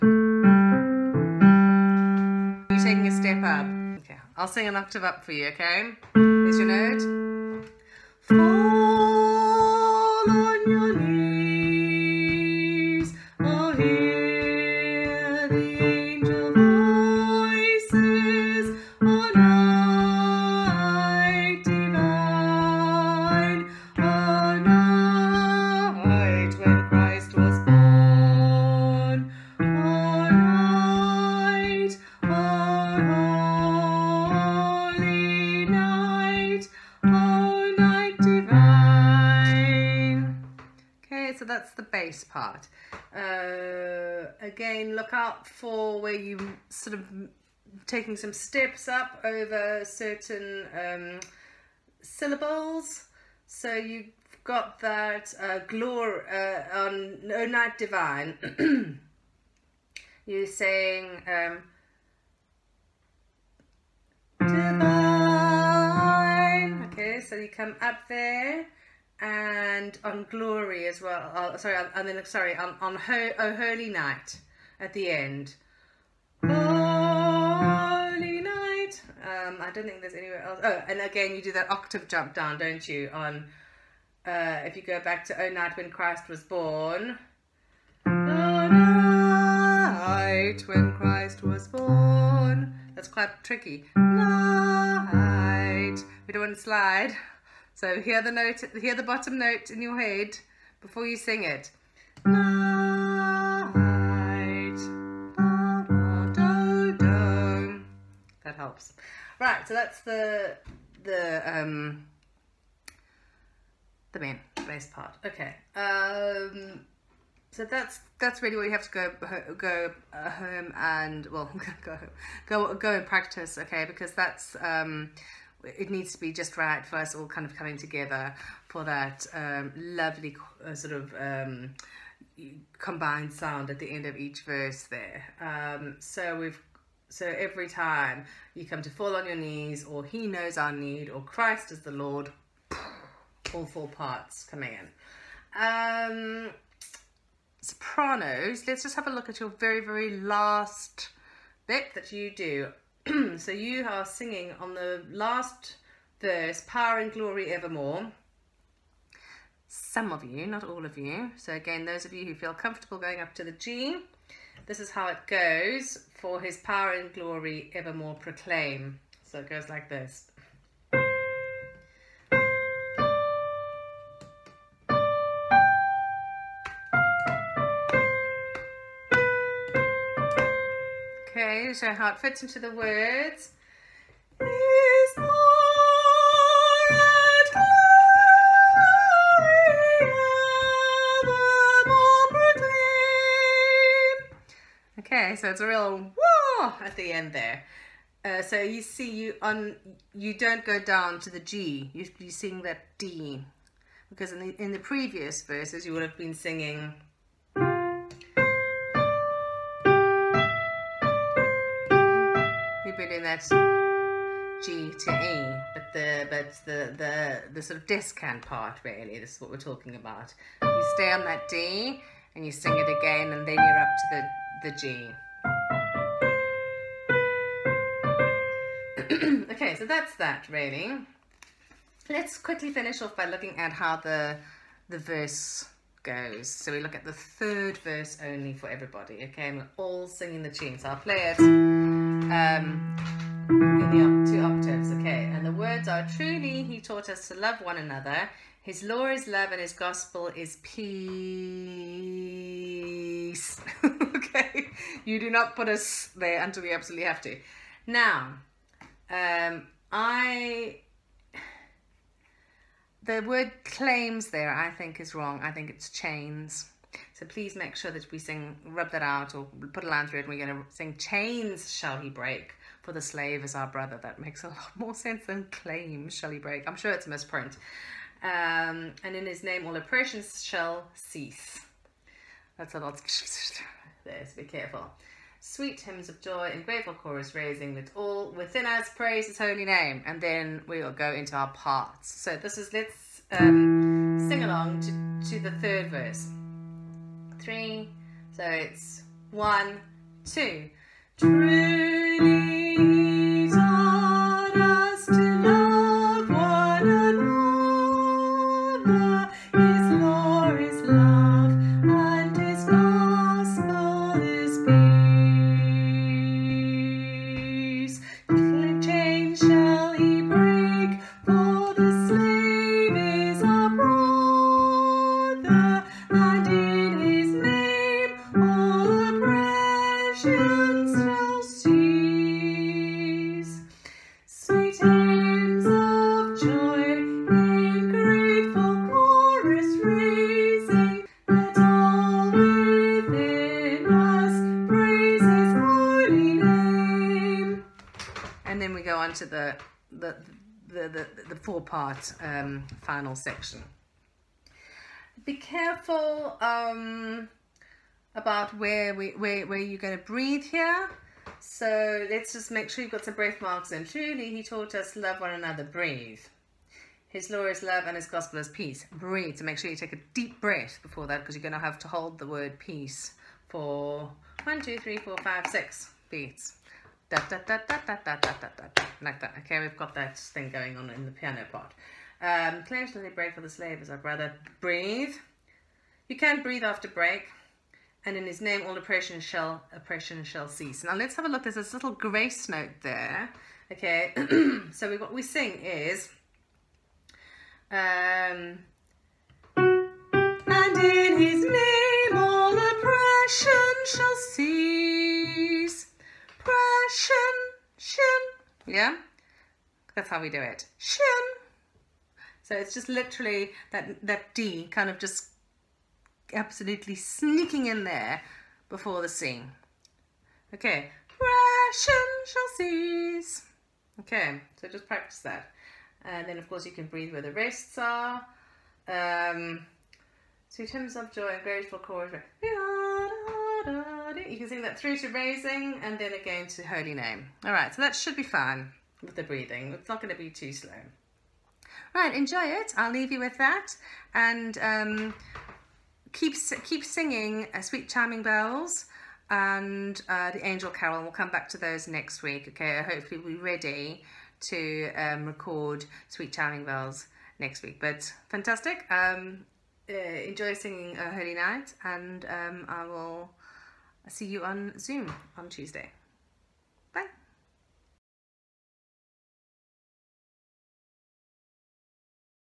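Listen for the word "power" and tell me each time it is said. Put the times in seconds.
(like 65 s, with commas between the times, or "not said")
156 s, 166 s.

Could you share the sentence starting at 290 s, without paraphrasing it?
And then we'll go into our parts.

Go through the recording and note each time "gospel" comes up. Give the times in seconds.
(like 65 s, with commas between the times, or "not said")
249 s, 368 s.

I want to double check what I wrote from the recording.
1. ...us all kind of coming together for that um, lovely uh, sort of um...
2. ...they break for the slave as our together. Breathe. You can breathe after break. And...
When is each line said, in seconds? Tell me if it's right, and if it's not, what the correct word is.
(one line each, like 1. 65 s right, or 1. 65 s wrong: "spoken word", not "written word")
1. 126 s right
2. 383 s wrong: "brother", not "together".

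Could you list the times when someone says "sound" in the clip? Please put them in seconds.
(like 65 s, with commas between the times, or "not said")
133 s.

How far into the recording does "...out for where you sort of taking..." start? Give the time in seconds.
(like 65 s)
45 s.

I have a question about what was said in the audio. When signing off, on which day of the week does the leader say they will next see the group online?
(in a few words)
Tuesday.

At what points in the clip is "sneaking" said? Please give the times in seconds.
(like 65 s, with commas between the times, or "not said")
416 s.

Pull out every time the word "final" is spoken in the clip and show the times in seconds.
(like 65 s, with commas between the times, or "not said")
352 s.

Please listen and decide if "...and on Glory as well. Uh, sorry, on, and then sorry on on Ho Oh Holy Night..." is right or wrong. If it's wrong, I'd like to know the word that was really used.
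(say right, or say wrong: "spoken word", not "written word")
right.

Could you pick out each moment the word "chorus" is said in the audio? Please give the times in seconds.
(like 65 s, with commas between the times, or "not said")
286 s, 431 s.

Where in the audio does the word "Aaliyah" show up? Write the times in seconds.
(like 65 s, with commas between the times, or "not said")
not said.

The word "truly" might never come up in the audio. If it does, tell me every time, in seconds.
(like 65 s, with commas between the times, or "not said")
246 s, 363 s.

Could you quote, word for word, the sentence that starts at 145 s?
Um, sopranos, let's just have a look at your very, very last bit that you do.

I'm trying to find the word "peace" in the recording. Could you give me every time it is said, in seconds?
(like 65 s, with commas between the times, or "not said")
250 s, 368 s, 372 s.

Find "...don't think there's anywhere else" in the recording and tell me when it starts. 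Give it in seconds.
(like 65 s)
79 s.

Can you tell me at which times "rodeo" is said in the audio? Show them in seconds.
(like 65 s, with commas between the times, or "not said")
not said.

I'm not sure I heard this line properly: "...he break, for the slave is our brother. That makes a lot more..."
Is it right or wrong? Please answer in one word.
right.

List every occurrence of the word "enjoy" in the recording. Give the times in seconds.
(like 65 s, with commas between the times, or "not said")
442 s, 459 s.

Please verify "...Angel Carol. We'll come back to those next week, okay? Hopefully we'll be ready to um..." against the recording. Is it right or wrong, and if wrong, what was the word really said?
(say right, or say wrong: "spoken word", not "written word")
right.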